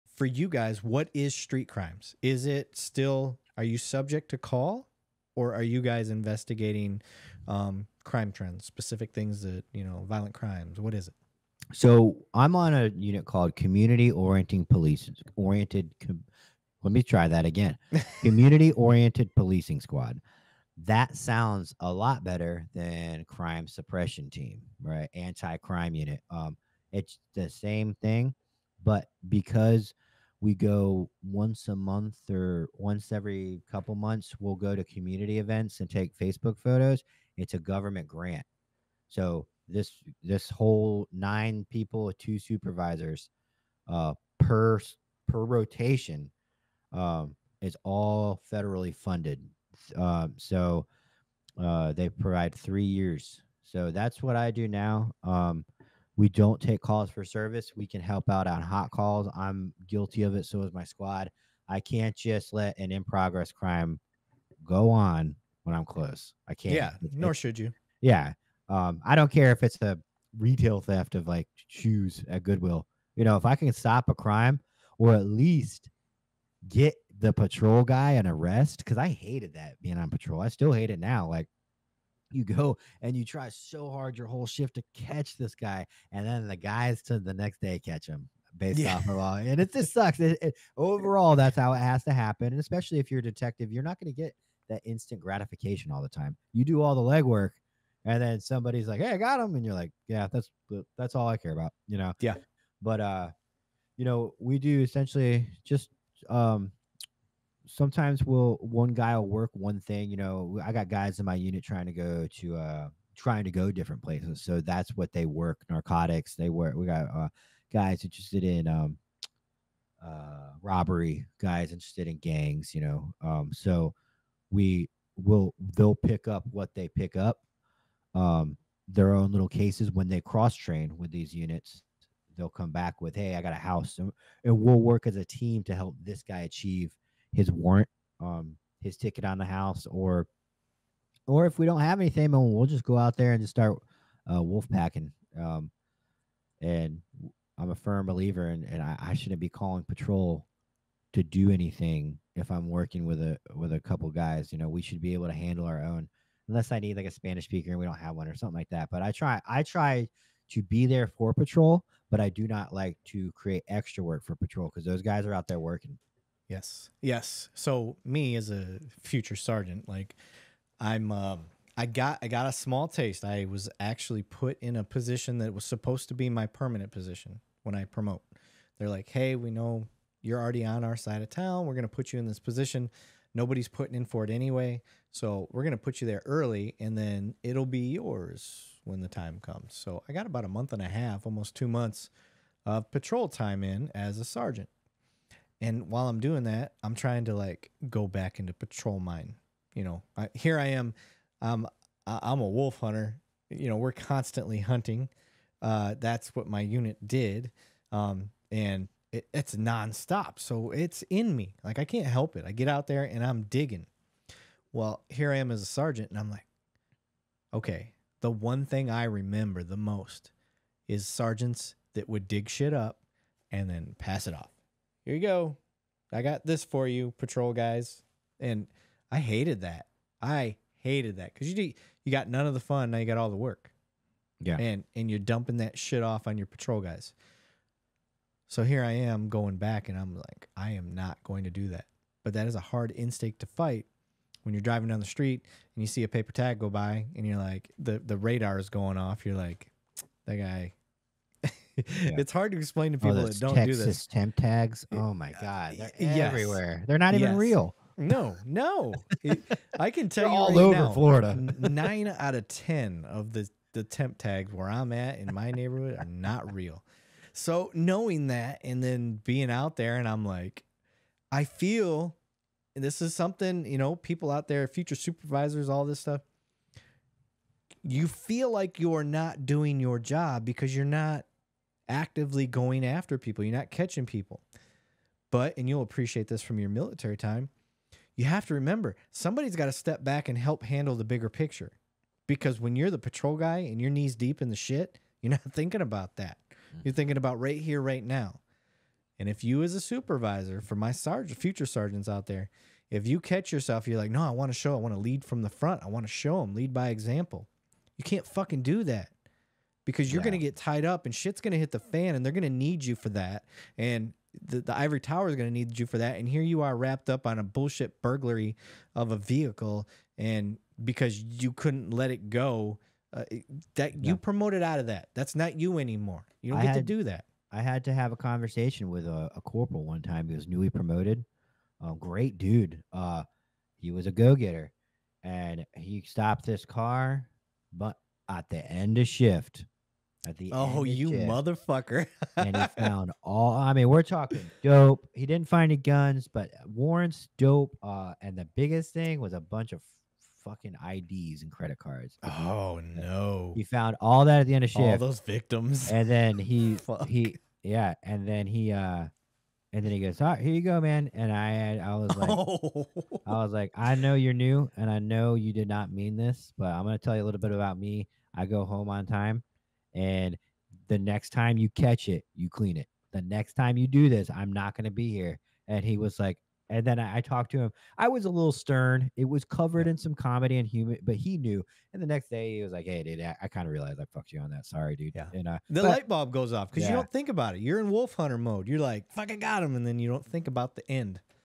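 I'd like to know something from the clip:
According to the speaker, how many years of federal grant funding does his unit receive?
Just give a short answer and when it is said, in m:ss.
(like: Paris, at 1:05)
3, at 0:52.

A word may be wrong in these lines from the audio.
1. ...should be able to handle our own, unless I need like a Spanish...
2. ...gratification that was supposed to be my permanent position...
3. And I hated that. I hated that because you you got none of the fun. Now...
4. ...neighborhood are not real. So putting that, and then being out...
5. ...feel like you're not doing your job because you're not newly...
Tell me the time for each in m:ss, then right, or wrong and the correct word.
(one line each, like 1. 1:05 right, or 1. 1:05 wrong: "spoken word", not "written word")
1. 2:34 right
2. 2:54 wrong: "position", not "gratification"
3. 3:48 right
4. 4:25 wrong: "knowing", not "putting"
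5. 4:38 wrong: "actively", not "newly".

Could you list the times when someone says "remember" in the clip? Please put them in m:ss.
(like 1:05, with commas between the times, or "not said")
3:39, 4:48.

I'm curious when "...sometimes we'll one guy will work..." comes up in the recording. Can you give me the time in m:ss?
1:47.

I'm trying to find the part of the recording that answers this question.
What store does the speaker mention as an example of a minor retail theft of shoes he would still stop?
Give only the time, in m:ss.
1:12.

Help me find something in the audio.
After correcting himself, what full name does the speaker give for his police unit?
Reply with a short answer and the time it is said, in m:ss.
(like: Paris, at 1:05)
Community Oriented Policing Squad, at 0:18.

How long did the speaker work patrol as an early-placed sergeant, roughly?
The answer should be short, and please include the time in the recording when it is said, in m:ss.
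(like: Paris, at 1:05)
Almost 2 months, at 3:11.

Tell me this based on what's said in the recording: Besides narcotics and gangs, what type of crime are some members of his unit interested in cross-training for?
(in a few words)
Robbery.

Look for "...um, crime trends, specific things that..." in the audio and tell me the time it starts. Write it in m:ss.
0:07.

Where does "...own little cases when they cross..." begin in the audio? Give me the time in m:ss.
2:09.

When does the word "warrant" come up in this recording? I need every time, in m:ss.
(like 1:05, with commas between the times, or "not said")
2:17, 5:46.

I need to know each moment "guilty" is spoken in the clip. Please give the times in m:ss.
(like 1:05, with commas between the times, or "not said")
0:59.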